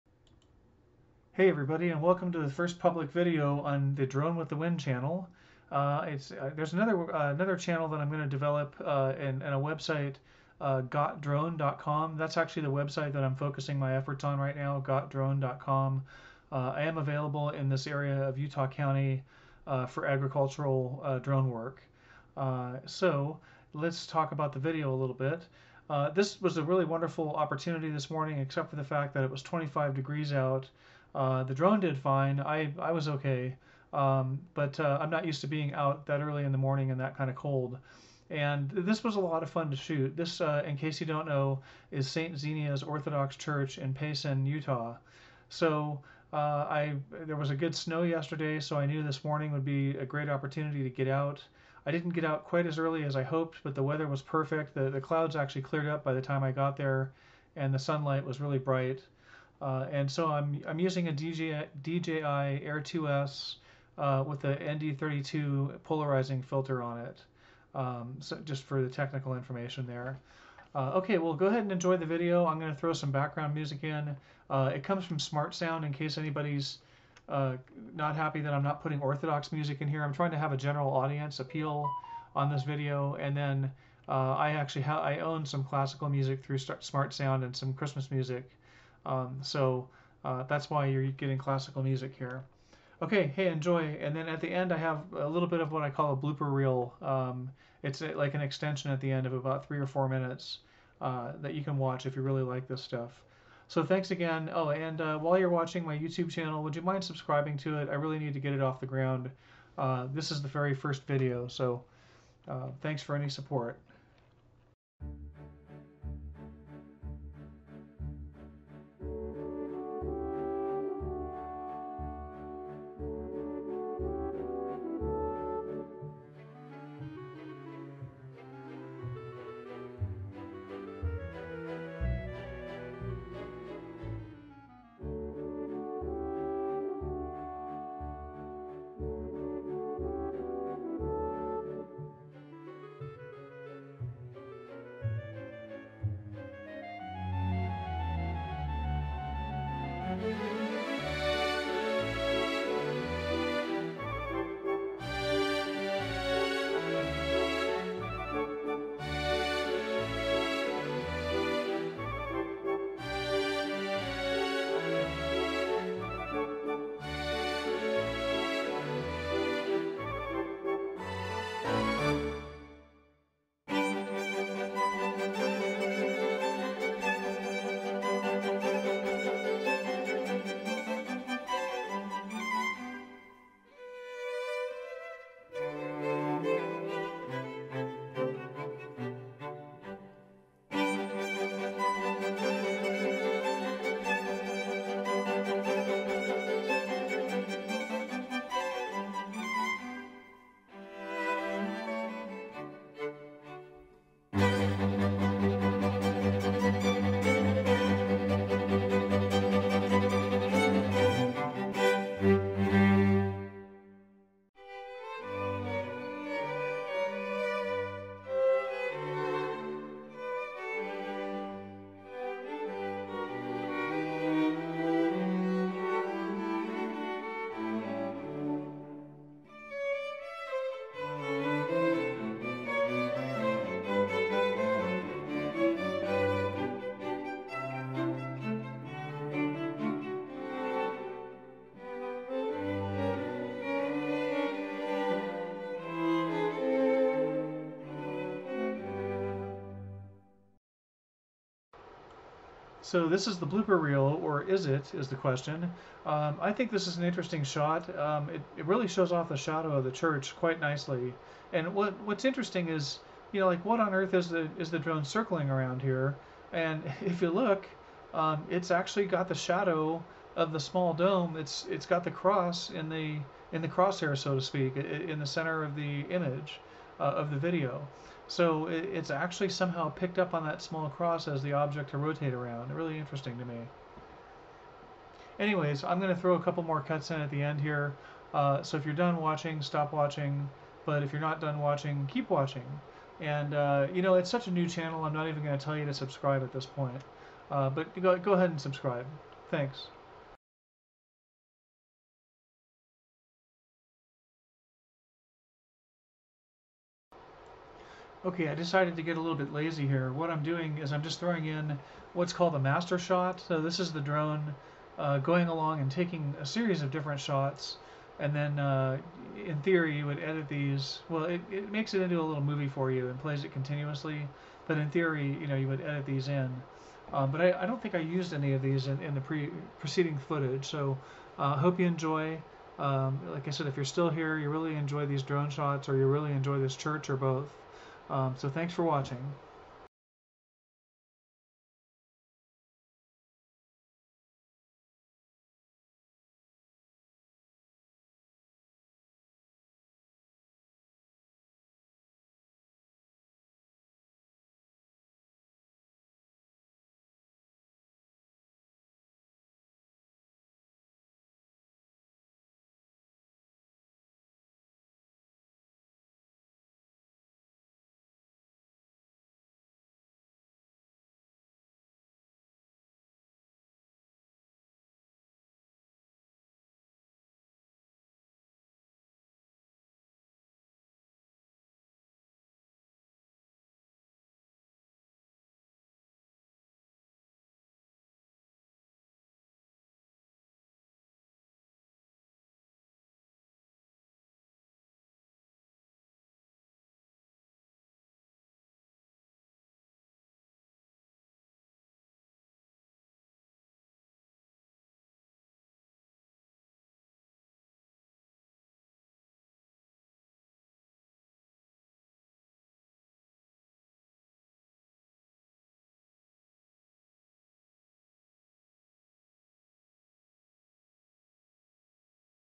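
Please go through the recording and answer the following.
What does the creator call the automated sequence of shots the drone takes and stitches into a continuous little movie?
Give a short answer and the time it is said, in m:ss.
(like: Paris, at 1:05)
master shot, at 5:12.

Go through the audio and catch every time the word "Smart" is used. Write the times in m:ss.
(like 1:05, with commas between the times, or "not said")
1:15, 1:26.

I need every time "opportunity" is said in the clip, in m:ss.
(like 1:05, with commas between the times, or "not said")
0:27, 0:50.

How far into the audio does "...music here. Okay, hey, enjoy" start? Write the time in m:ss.
1:31.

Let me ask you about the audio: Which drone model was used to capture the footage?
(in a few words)
DJI Air 2S.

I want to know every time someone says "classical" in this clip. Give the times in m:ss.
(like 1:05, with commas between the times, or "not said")
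1:25, 1:31.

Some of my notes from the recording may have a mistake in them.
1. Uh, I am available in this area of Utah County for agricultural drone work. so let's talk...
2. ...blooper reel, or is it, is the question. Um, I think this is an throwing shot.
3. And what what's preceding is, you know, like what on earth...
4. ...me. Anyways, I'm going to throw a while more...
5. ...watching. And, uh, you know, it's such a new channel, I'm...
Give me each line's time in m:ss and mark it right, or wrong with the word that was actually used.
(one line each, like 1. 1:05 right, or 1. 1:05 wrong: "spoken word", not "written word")
1. 0:16 right
2. 4:13 wrong: "interesting", not "throwing"
3. 4:21 wrong: "interesting", not "preceding"
4. 4:43 wrong: "couple", not "while"
5. 4:52 right.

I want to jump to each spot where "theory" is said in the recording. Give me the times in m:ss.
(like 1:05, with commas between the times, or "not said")
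5:19, 5:24.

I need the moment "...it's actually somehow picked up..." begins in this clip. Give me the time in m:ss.
4:38.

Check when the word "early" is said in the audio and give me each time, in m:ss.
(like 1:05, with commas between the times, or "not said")
0:36, 0:52.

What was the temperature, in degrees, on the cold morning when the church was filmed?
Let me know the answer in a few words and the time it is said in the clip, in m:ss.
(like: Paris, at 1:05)
25, at 0:29.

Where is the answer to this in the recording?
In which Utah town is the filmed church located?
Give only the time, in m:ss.
0:43.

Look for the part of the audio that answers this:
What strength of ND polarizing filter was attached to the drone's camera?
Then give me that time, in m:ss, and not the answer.
1:04.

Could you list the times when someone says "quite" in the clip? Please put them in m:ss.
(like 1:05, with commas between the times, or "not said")
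0:52, 4:20.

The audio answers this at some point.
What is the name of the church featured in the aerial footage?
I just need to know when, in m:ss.
0:42.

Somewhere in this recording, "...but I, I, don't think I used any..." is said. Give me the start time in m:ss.
5:27.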